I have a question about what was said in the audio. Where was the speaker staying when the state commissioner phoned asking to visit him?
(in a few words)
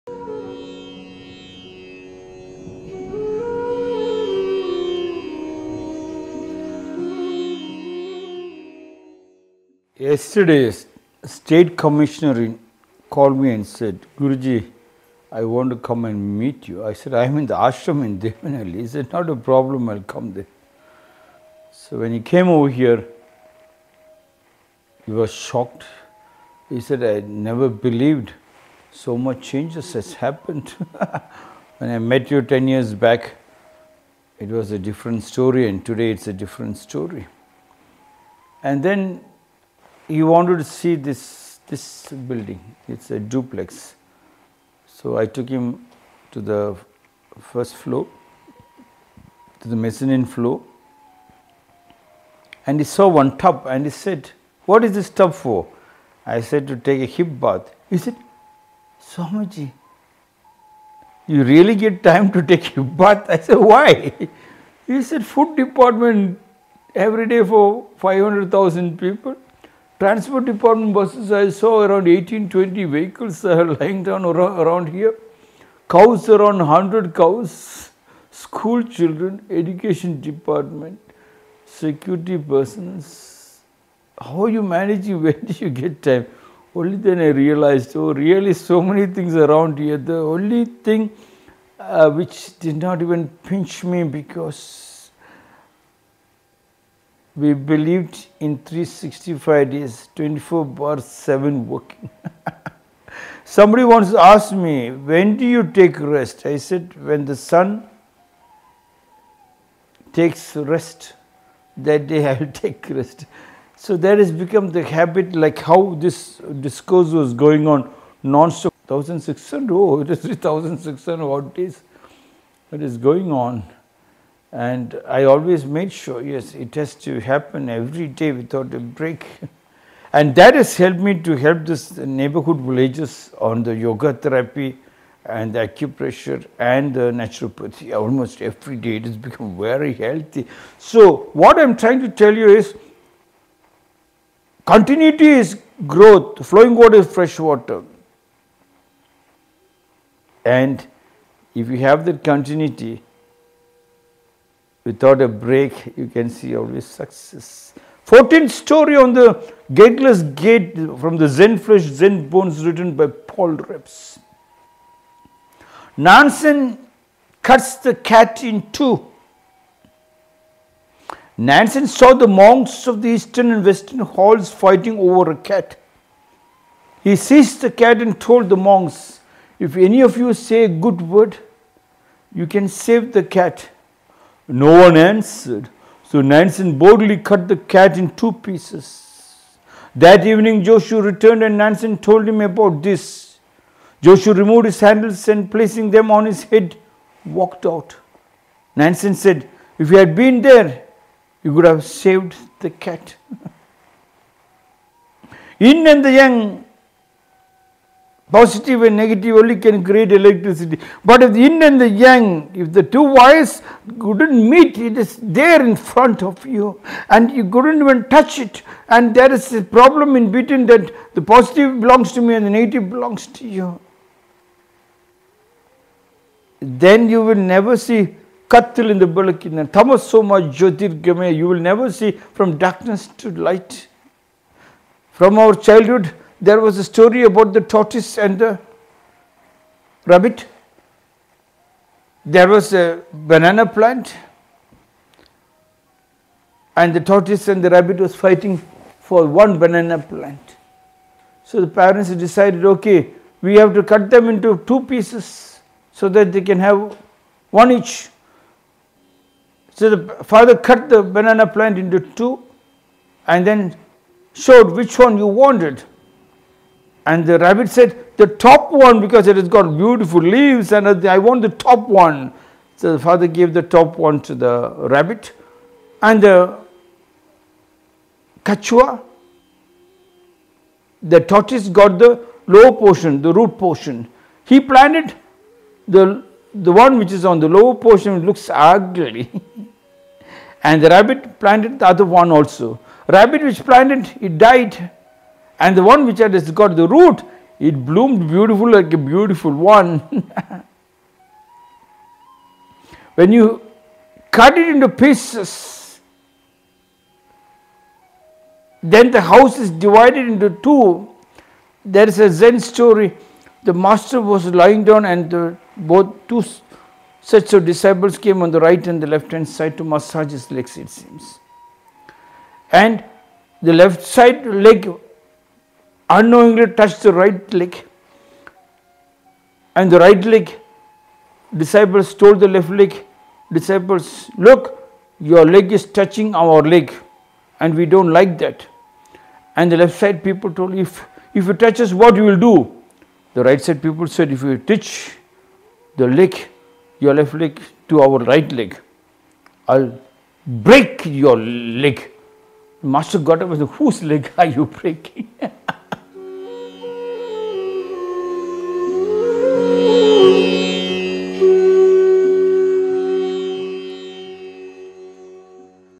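Devanahalli.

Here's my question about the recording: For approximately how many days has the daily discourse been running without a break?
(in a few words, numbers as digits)
3600.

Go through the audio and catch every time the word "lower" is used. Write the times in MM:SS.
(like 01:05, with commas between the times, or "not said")
04:47.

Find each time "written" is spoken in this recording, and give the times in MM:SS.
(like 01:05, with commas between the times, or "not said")
02:42.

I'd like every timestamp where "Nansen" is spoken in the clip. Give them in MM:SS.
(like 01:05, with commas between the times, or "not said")
02:45, 02:51, 03:06, 03:11, 03:18.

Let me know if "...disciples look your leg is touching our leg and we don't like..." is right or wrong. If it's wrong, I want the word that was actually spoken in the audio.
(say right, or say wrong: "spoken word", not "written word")
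right.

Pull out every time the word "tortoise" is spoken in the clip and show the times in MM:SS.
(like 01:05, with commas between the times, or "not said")
03:57, 04:06, 04:41.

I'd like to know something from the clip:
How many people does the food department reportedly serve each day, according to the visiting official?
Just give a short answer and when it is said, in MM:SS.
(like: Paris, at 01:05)
500,000, at 01:07.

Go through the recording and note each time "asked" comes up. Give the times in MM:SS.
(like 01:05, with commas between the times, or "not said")
01:44.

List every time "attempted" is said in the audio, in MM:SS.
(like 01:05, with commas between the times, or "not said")
not said.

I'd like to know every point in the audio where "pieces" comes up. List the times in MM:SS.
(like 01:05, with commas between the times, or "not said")
03:08, 04:14, 05:04.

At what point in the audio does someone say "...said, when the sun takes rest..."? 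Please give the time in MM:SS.
01:46.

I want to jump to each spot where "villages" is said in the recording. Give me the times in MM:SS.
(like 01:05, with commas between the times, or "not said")
02:12.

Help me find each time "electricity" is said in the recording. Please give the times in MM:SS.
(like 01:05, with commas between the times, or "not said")
03:30.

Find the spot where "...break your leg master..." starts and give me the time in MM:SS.
05:50.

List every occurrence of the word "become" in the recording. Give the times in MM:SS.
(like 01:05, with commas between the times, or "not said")
01:54, 02:19.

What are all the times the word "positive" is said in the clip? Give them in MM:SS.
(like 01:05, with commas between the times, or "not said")
03:28, 03:41.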